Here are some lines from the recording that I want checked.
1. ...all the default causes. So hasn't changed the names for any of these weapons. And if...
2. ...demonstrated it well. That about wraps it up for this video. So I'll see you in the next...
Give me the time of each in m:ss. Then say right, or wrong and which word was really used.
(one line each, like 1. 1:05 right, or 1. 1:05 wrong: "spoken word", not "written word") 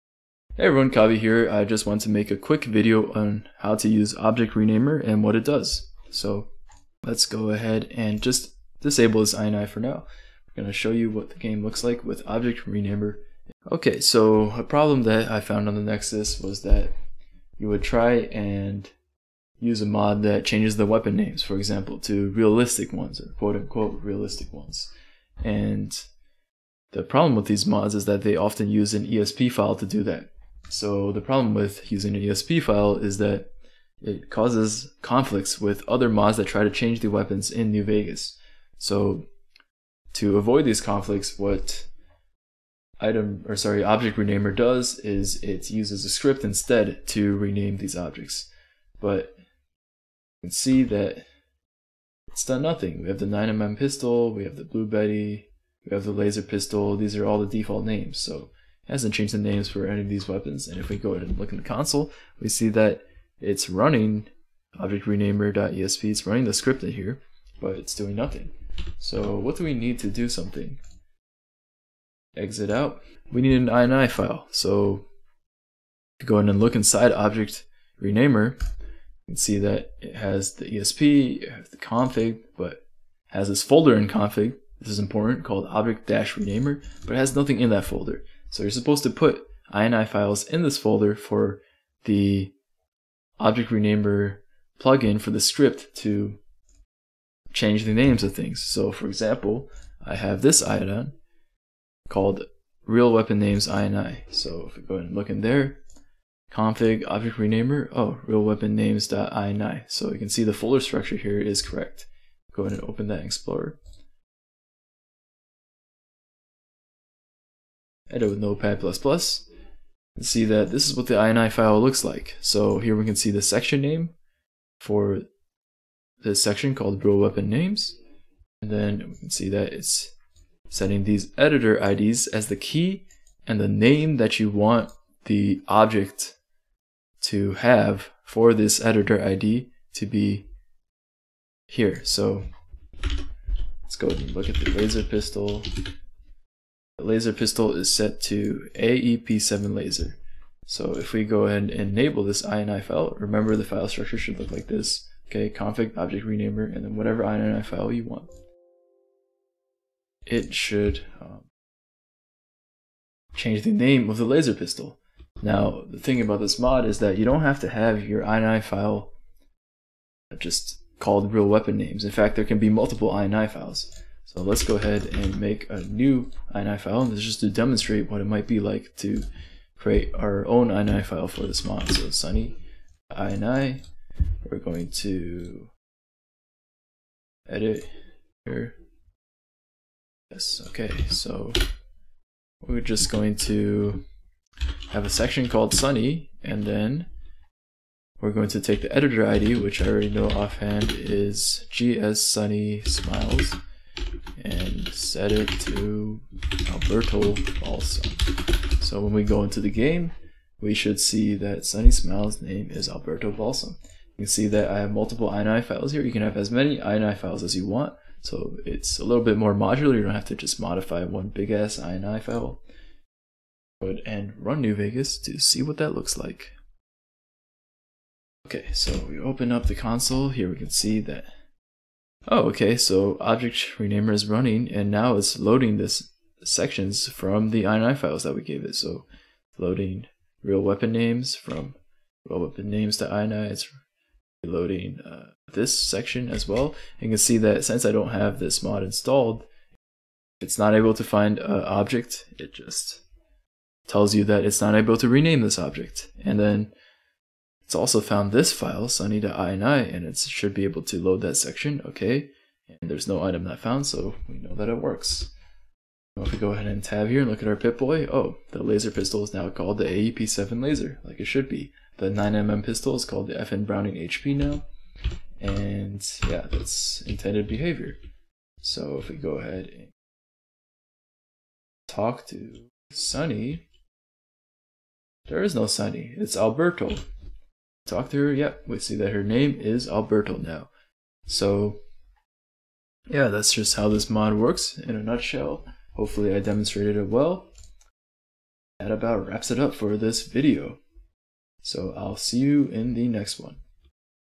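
1. 0:57 wrong: "names", not "causes"
2. 4:56 right.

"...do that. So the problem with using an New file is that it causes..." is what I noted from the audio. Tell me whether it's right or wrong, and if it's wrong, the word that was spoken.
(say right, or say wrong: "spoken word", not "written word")
wrong: "ESP", not "New".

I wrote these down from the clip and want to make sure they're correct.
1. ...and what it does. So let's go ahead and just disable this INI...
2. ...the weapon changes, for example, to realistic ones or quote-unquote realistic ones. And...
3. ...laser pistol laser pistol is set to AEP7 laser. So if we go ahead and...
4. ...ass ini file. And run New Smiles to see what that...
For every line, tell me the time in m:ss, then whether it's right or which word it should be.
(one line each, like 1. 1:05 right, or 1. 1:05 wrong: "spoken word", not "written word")
1. 0:05 right
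2. 0:20 wrong: "names", not "changes"
3. 2:24 right
4. 3:41 wrong: "Vegas", not "Smiles".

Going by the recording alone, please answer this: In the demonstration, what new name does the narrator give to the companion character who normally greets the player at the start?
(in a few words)
Alberto Balsam.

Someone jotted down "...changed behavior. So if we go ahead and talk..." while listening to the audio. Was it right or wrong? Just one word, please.
wrong.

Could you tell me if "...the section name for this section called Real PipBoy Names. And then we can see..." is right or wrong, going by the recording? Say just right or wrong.
wrong.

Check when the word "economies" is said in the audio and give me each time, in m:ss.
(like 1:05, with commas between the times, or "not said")
not said.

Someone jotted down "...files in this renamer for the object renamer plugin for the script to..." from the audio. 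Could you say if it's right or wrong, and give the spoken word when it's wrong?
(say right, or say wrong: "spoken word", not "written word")
wrong: "folder", not "renamer".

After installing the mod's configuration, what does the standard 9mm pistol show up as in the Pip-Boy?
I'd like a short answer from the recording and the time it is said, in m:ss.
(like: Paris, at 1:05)
FN Browning HP, at 4:33.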